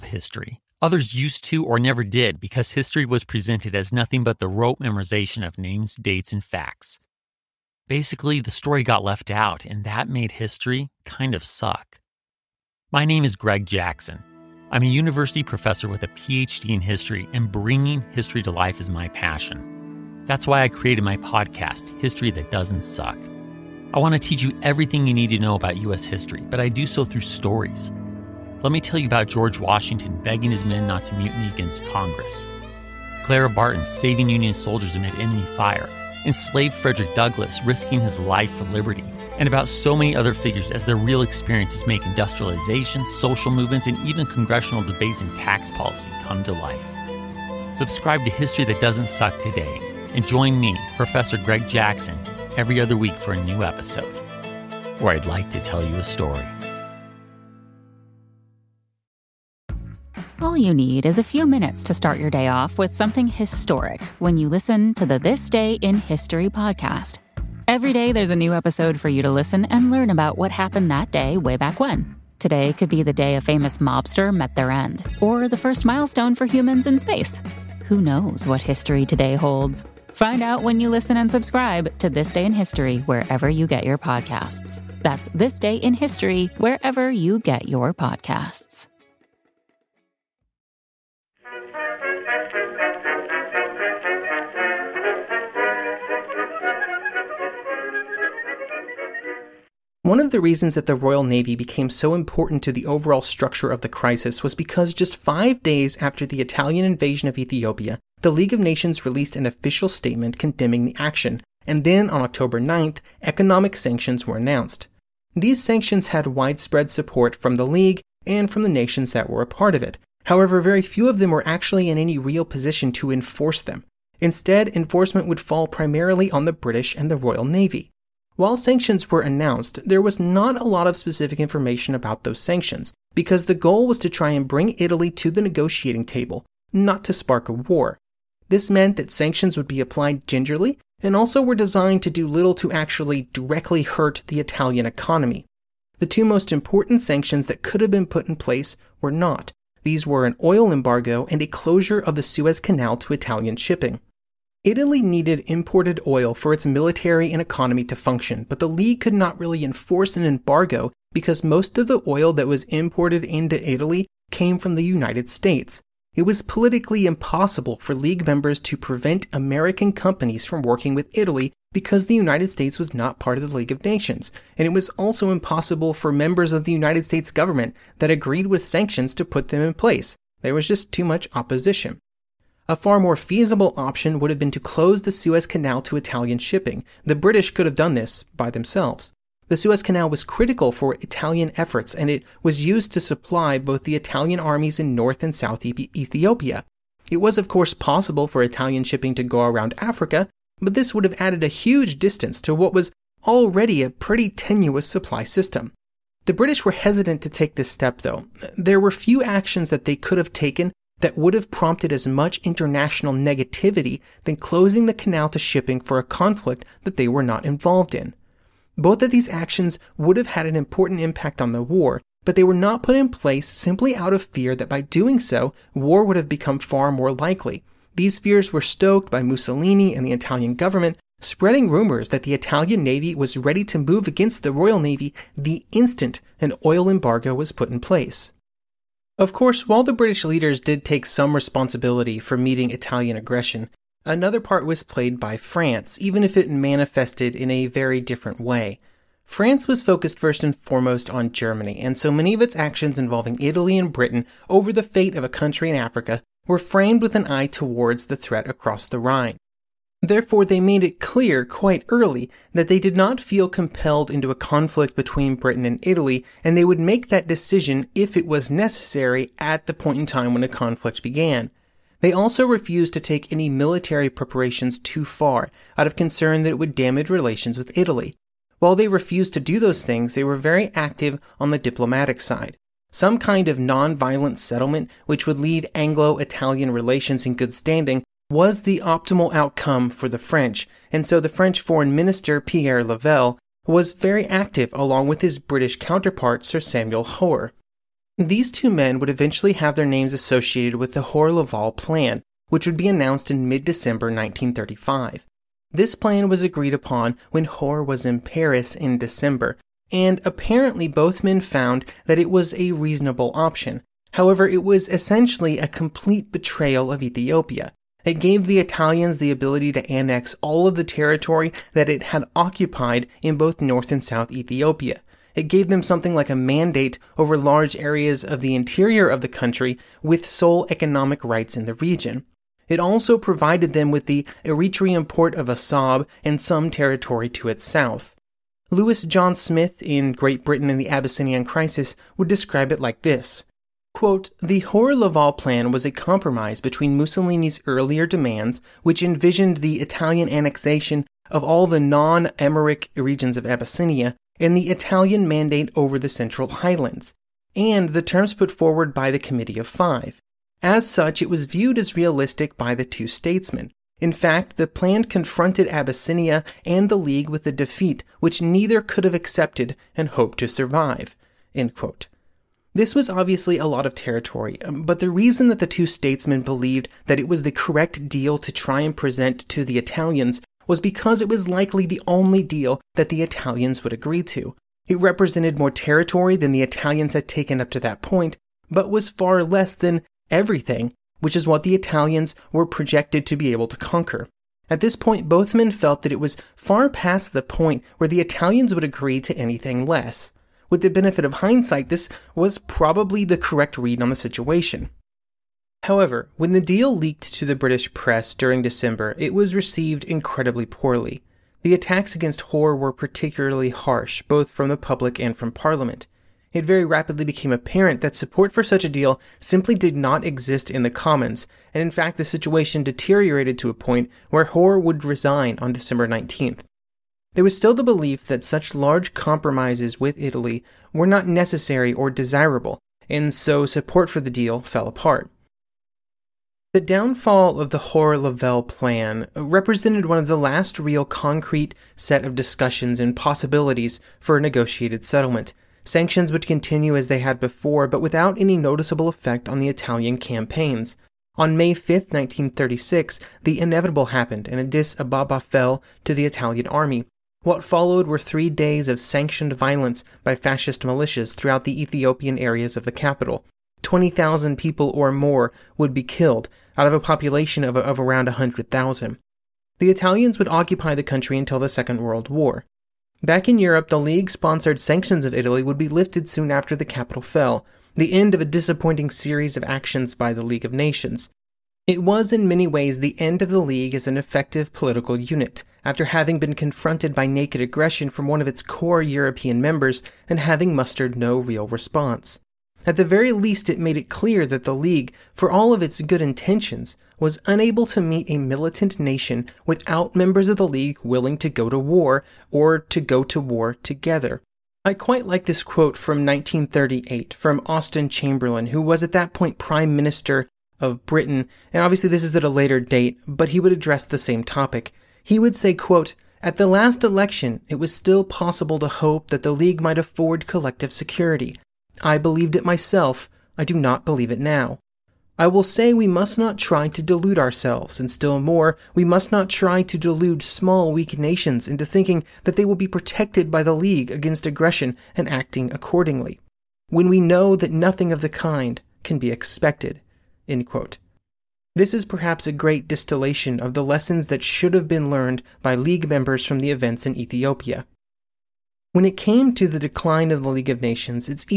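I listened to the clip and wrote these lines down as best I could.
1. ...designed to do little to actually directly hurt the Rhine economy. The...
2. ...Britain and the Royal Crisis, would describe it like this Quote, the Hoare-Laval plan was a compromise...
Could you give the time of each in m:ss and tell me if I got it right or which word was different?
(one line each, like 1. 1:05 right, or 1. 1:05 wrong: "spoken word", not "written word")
1. 2:21 wrong: "Italian", not "Rhine"
2. 5:40 wrong: "Abyssinian", not "Royal".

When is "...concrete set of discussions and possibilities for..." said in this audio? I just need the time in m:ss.
7:21.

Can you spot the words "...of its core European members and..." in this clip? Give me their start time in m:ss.
8:08.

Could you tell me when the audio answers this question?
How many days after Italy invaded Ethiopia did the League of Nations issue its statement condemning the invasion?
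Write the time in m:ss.
1:45.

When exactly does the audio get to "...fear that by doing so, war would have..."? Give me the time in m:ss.
3:44.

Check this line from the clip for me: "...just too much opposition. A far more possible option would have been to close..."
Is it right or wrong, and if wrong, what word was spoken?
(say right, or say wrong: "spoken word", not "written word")
wrong: "feasible", not "possible".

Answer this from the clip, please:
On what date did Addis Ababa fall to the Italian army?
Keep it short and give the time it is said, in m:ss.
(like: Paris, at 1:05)
May 5, 1936, at 7:31.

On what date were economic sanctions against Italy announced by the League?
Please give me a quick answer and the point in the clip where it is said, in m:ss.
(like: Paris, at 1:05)
October 9th, at 1:52.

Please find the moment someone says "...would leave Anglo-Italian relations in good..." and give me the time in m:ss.
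4:45.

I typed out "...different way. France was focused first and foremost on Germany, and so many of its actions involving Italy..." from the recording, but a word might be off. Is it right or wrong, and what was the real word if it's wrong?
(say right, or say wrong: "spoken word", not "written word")
right.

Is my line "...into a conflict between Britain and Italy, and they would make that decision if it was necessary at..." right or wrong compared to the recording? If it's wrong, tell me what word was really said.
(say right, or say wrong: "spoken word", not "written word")
right.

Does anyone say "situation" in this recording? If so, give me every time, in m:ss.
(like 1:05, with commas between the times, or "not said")
6:44, 7:02.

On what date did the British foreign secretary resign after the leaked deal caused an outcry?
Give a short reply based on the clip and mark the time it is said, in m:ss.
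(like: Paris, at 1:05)
December 19th, at 7:05.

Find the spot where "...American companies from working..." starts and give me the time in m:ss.
2:49.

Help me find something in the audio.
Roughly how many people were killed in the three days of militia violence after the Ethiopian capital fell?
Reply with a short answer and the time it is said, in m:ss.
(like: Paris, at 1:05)
20,000, at 7:43.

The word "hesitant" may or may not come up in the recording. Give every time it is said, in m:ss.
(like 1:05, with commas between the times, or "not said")
3:26.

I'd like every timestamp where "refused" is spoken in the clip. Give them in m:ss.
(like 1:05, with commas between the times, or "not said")
4:32, 4:38.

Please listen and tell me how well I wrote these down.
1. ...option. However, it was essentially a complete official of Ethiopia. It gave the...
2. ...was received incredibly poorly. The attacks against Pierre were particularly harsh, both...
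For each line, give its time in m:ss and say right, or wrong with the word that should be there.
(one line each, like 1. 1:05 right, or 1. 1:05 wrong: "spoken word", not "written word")
1. 5:13 wrong: "betrayal", not "official"
2. 6:49 wrong: "Hoare", not "Pierre".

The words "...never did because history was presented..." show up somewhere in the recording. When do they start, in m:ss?
0:01.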